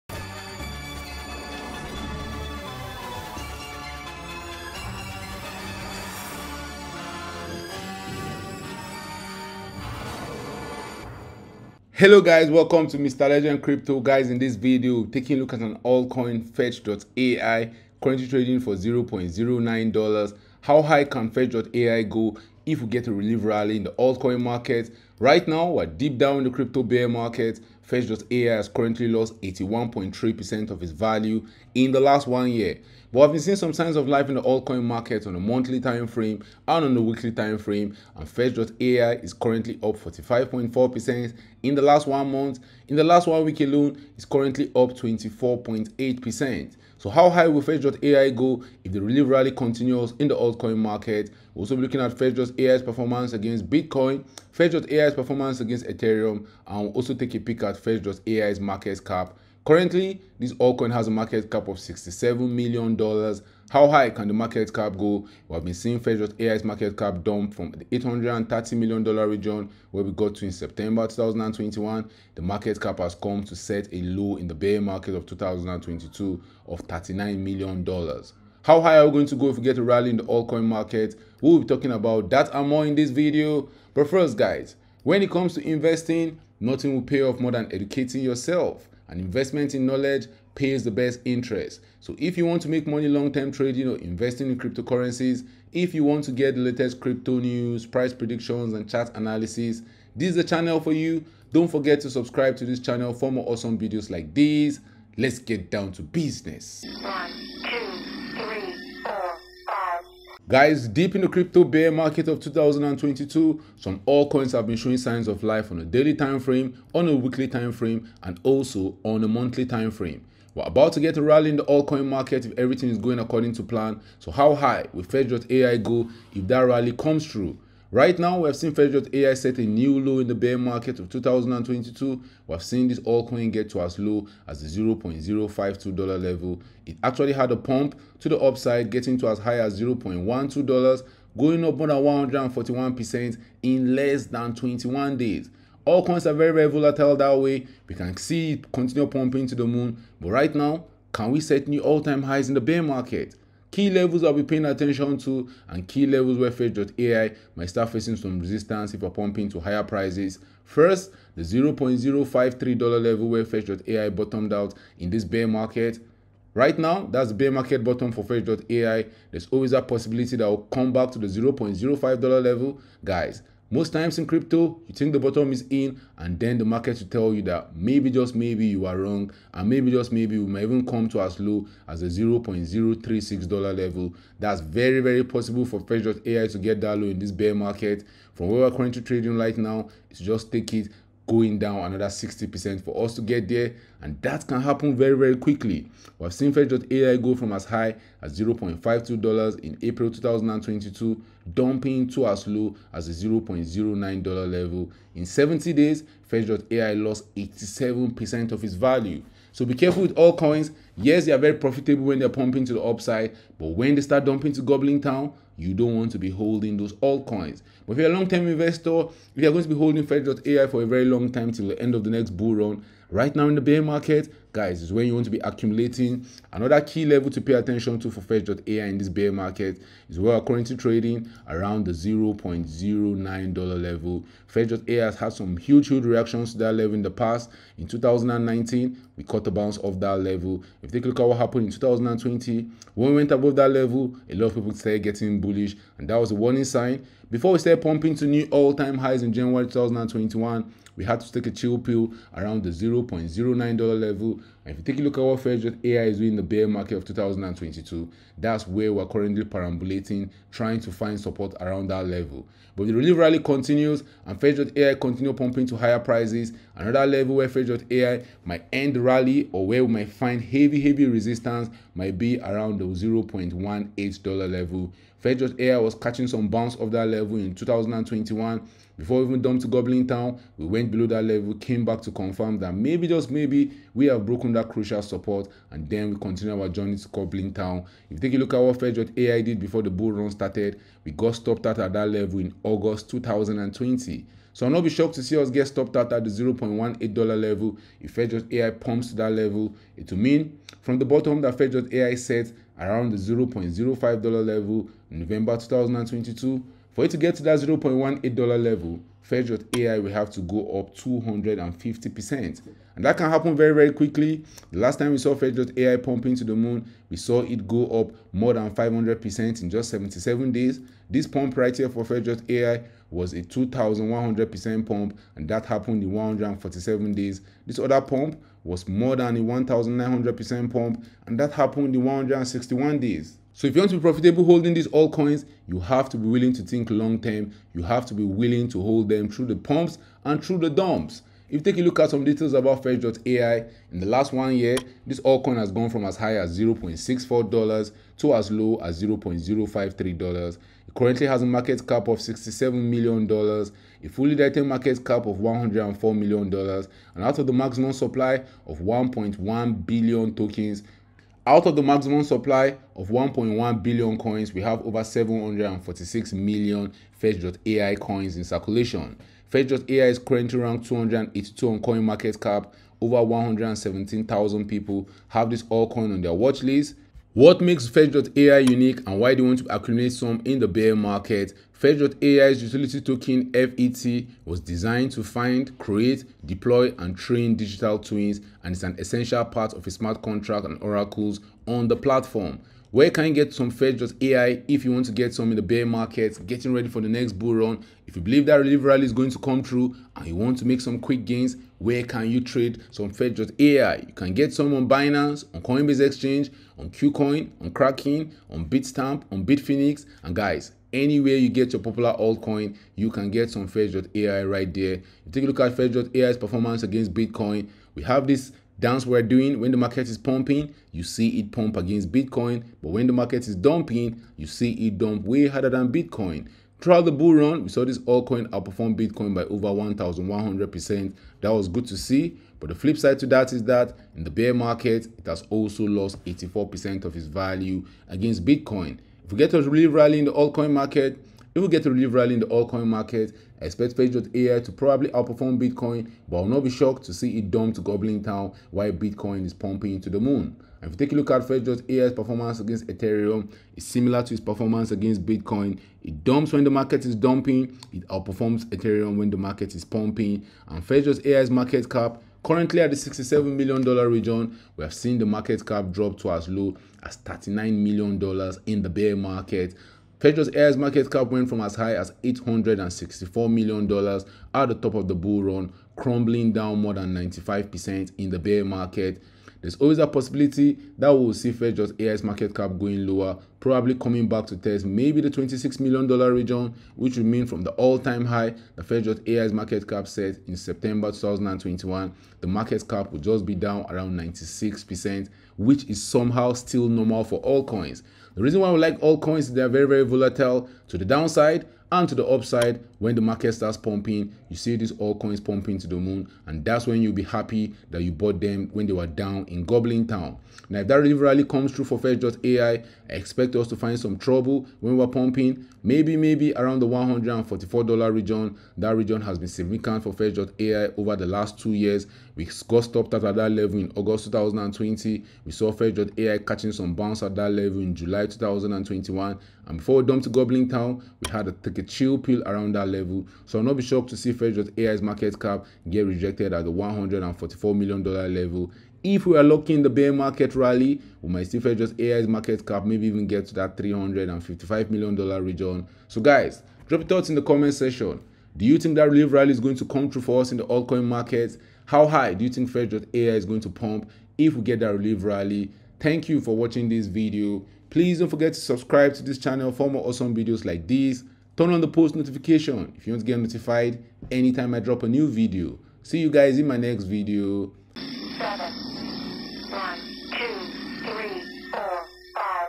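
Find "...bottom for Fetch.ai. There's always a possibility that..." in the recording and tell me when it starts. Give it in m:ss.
2:47.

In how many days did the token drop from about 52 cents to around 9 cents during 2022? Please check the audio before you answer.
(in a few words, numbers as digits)
70 days.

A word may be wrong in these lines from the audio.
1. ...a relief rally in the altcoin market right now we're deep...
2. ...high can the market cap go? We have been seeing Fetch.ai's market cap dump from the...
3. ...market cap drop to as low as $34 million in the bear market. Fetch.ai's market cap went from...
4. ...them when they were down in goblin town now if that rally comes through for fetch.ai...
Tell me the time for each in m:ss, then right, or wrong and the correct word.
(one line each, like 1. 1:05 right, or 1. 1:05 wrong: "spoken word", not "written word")
1. 0:23 right
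2. 1:03 right
3. 7:45 wrong: "39", not "34"
4. 8:28 right.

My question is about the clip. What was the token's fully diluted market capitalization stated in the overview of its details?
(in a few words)
$104 million.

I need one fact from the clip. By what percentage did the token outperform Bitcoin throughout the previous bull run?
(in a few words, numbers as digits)
over 1,100%.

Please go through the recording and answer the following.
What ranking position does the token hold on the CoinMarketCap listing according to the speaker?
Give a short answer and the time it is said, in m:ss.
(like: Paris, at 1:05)
282, at 6:10.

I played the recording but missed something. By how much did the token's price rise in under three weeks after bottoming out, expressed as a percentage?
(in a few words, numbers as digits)
more than 141%.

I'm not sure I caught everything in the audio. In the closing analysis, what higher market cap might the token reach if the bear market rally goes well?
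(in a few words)
$355 million.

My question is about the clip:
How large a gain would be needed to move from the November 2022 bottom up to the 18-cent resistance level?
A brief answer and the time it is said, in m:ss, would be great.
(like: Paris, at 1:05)
250%, at 5:10.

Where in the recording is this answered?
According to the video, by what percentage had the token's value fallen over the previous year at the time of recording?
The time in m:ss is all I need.
0:29.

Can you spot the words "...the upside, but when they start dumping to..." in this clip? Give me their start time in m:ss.
3:32.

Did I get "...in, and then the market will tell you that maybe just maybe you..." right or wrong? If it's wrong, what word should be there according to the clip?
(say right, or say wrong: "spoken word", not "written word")
right.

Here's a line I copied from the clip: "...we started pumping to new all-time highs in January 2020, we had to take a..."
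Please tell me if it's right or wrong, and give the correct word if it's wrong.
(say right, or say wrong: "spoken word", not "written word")
wrong: "2021", not "2020".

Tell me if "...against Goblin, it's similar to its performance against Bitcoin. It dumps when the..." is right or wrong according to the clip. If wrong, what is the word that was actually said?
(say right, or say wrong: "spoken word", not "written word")
wrong: "Ethereum", not "Goblin".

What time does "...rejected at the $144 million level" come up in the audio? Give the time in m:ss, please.
8:56.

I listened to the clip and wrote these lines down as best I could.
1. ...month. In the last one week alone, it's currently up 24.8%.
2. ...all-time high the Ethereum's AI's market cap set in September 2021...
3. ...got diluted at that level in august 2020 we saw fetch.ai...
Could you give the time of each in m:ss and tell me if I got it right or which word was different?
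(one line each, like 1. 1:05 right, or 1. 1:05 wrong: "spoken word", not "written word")
1. 0:42 right
2. 8:07 wrong: "Fed", not "Ethereum"
3. 8:42 wrong: "stopped", not "diluted".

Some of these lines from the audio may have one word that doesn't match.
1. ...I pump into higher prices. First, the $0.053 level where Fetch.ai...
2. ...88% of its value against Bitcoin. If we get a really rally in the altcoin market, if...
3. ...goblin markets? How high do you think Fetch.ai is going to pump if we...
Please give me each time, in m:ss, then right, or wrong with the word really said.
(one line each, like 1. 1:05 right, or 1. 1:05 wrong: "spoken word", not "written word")
1. 2:39 right
2. 7:16 wrong: "84", not "88"
3. 9:10 wrong: "altcoin", not "goblin".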